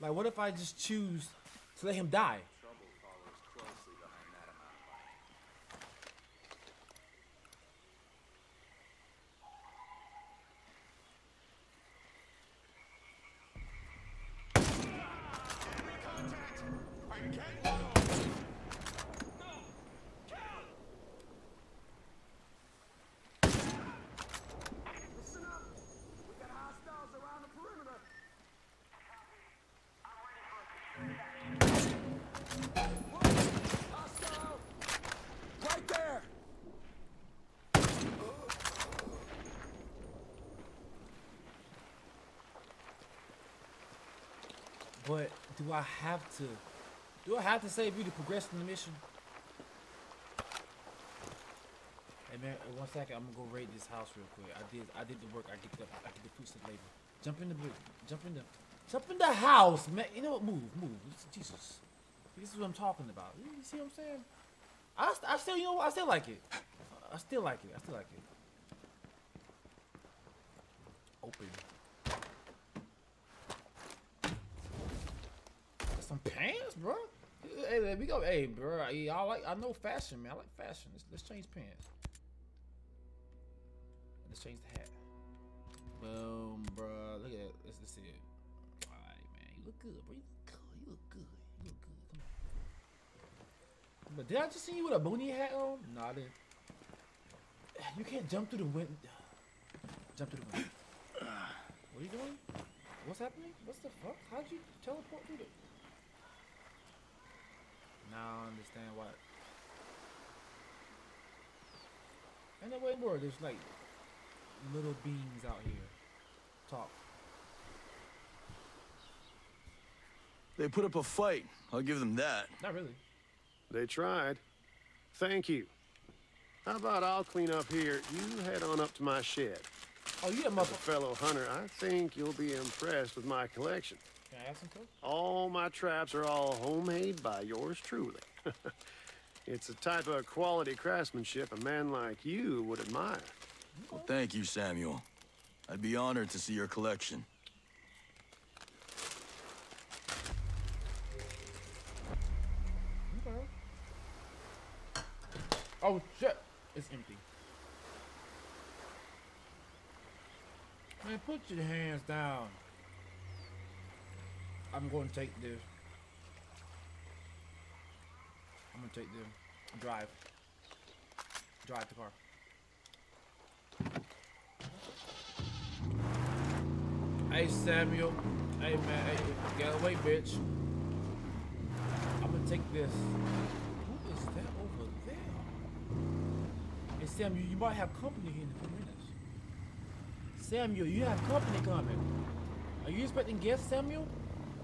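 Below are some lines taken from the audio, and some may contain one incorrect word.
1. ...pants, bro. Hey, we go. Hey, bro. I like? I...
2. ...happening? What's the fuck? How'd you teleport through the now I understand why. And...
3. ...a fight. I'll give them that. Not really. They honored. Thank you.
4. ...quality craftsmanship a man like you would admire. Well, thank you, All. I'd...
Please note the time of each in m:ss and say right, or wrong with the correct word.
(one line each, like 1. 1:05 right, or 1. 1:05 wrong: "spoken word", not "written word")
1. 1:16 right
2. 1:43 right
3. 2:00 wrong: "tried", not "honored"
4. 2:20 wrong: "Samuel", not "All".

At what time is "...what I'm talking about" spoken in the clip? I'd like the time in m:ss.
1:02.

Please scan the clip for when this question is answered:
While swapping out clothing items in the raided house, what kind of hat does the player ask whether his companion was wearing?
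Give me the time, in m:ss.
1:34.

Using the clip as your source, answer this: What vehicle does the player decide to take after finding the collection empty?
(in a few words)
the car.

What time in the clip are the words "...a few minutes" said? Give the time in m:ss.
3:08.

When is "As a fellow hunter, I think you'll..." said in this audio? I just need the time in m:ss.
2:10.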